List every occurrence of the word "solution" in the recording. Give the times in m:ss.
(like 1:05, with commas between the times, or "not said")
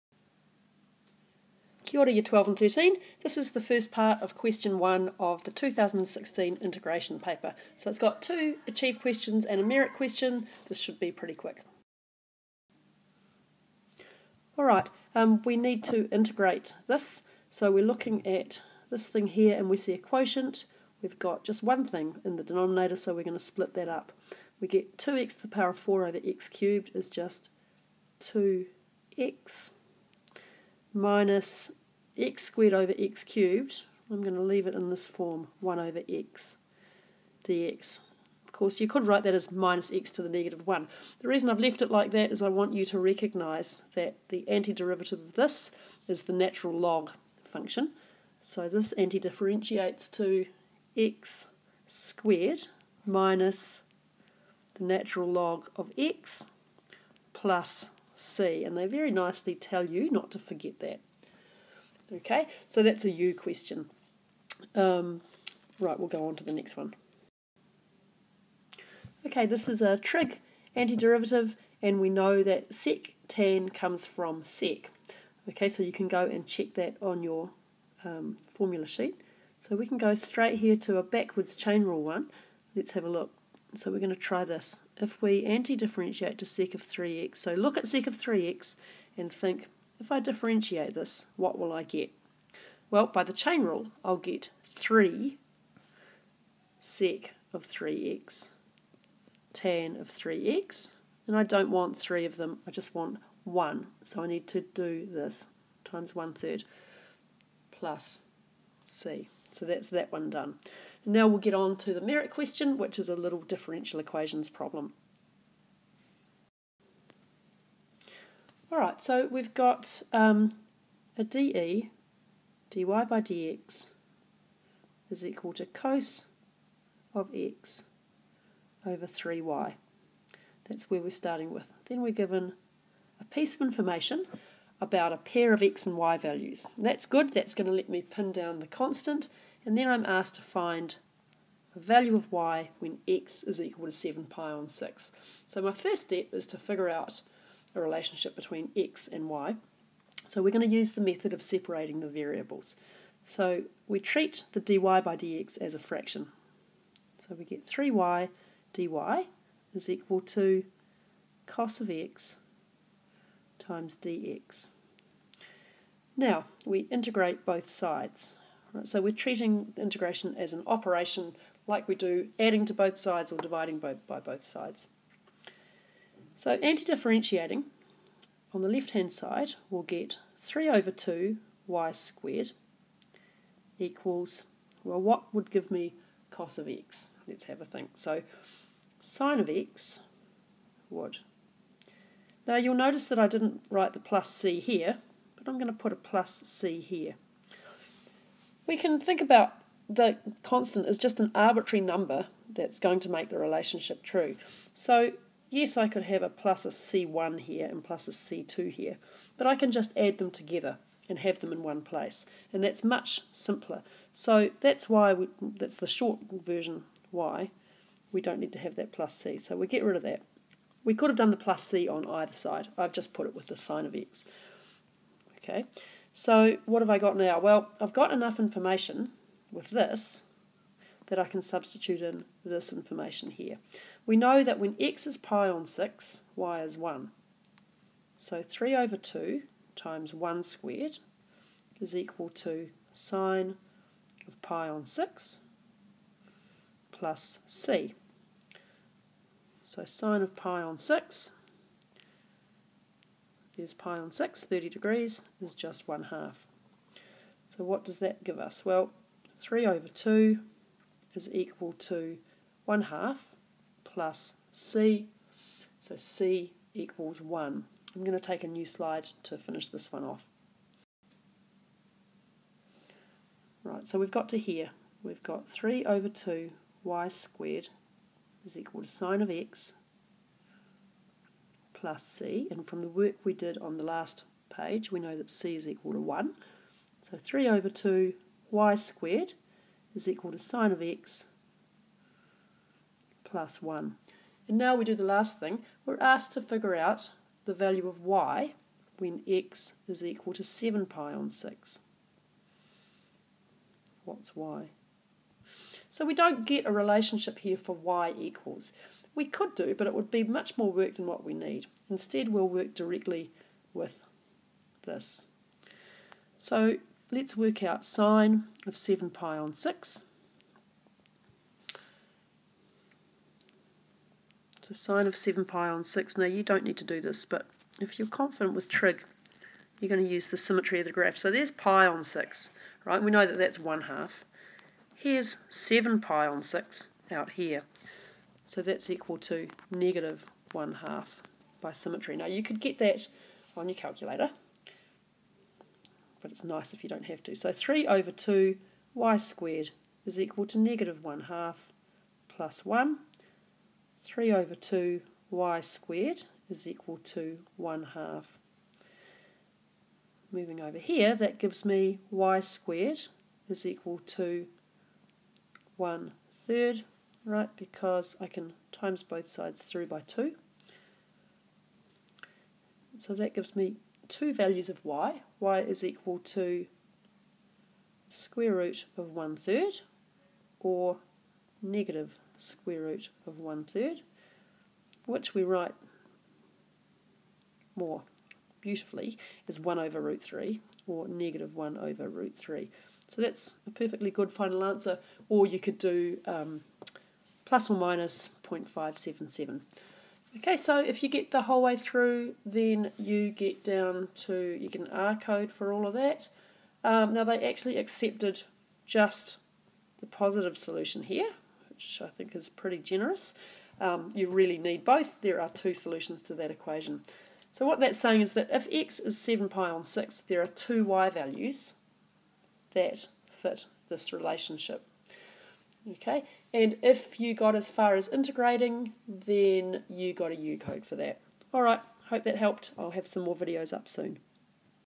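6:50, 6:55.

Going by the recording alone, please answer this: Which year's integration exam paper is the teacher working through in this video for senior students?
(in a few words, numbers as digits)
2016.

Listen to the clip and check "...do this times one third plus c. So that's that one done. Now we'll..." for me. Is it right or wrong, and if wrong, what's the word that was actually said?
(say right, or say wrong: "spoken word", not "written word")
right.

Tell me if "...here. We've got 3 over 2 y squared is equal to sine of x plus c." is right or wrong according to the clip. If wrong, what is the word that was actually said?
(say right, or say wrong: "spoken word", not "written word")
right.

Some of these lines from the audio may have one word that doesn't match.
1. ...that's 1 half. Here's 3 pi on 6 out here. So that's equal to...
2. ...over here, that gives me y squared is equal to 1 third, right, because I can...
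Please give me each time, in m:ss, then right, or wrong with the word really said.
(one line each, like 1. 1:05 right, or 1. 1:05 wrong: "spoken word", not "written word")
1. 5:33 wrong: "7", not "3"
2. 6:00 right.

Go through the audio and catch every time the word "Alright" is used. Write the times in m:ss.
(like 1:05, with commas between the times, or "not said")
0:14, 7:11.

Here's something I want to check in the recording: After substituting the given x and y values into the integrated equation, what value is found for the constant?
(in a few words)
1.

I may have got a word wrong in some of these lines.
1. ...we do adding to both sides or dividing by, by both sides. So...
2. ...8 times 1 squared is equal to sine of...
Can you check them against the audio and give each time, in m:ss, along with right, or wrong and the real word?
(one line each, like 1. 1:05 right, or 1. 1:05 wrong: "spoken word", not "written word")
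1. 2:51 right
2. 3:58 wrong: "2", not "8".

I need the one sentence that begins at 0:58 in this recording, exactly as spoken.
And they very nicely tell you not to forget that.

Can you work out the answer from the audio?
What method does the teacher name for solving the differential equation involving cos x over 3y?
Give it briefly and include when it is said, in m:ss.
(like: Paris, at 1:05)
separating the variables, at 2:31.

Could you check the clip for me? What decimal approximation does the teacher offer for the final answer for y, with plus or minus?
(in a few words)
0.577.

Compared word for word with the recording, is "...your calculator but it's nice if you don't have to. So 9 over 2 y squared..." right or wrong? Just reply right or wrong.
wrong.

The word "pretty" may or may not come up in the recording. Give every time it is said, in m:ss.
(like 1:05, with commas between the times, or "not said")
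0:11, 6:52.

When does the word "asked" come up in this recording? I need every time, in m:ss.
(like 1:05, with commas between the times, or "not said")
2:20, 4:55.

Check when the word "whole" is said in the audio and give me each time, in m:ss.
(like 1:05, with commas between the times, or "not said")
6:41.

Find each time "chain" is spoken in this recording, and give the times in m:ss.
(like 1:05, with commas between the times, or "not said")
1:21, 1:33.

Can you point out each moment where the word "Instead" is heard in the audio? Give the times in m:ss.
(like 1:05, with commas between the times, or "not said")
5:11.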